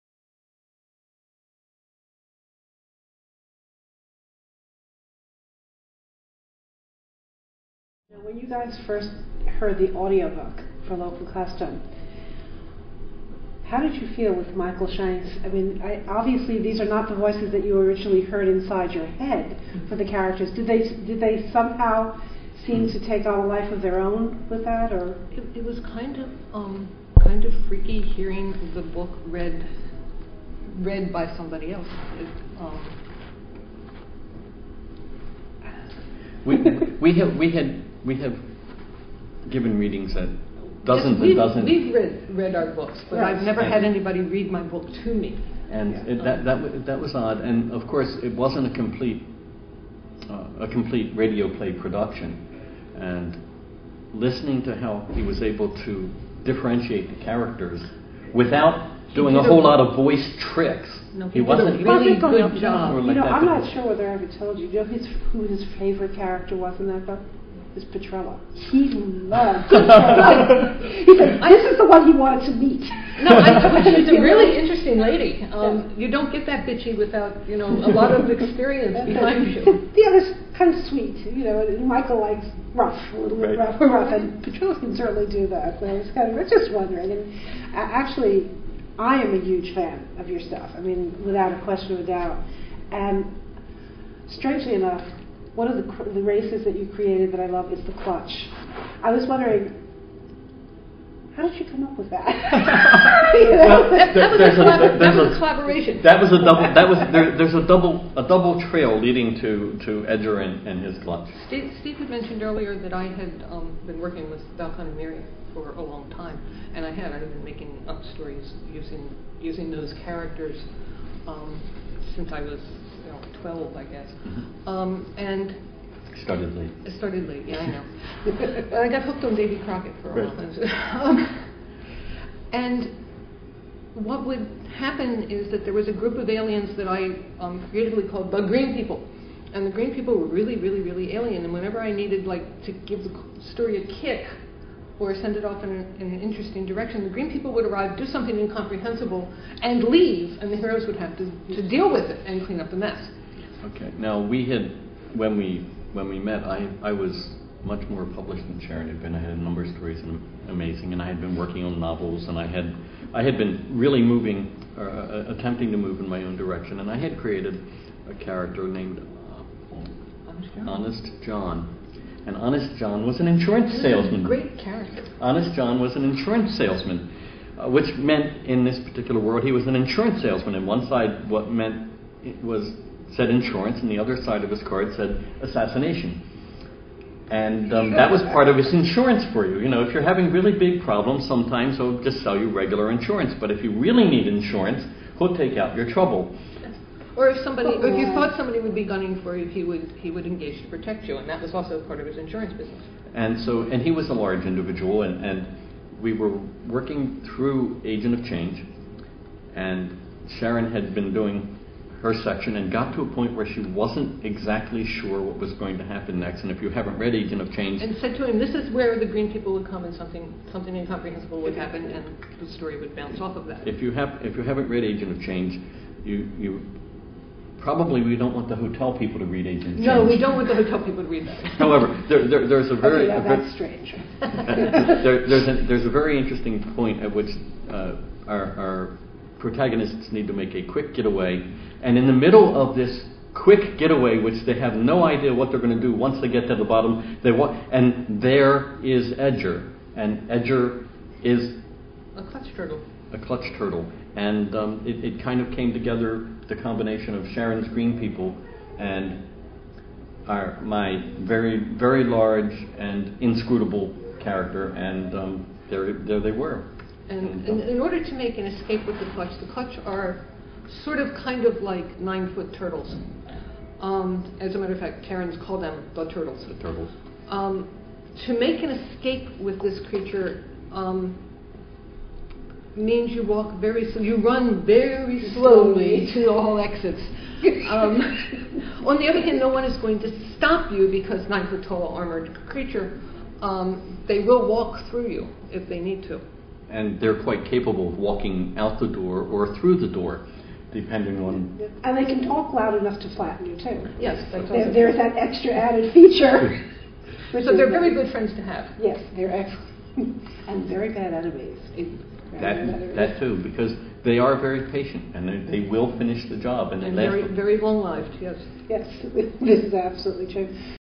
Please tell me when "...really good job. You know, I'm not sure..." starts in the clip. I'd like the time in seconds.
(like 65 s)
61 s.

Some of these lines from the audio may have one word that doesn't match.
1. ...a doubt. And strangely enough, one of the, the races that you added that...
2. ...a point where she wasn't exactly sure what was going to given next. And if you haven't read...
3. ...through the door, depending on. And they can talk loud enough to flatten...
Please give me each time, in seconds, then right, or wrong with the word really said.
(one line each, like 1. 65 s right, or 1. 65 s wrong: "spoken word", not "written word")
1. 92 s wrong: "created", not "added"
2. 213 s wrong: "happen", not "given"
3. 299 s right.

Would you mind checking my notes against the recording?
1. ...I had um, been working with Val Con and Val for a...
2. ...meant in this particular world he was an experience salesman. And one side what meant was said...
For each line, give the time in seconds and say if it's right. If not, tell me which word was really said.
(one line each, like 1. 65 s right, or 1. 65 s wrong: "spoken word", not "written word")
1. 112 s wrong: "Miriam", not "Val"
2. 177 s wrong: "insurance", not "experience".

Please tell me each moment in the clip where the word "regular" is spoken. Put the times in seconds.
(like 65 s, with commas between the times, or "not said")
192 s.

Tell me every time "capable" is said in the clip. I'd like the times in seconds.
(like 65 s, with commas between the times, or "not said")
297 s.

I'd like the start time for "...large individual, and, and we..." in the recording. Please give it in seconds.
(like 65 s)
204 s.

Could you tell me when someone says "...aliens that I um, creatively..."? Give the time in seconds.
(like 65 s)
136 s.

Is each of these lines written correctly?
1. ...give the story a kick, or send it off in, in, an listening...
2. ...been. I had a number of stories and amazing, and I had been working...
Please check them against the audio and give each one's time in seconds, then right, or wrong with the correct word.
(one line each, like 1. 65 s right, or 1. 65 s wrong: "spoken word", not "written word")
1. 142 s wrong: "interesting", not "listening"
2. 159 s right.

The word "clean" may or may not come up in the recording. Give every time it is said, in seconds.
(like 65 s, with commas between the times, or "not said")
152 s.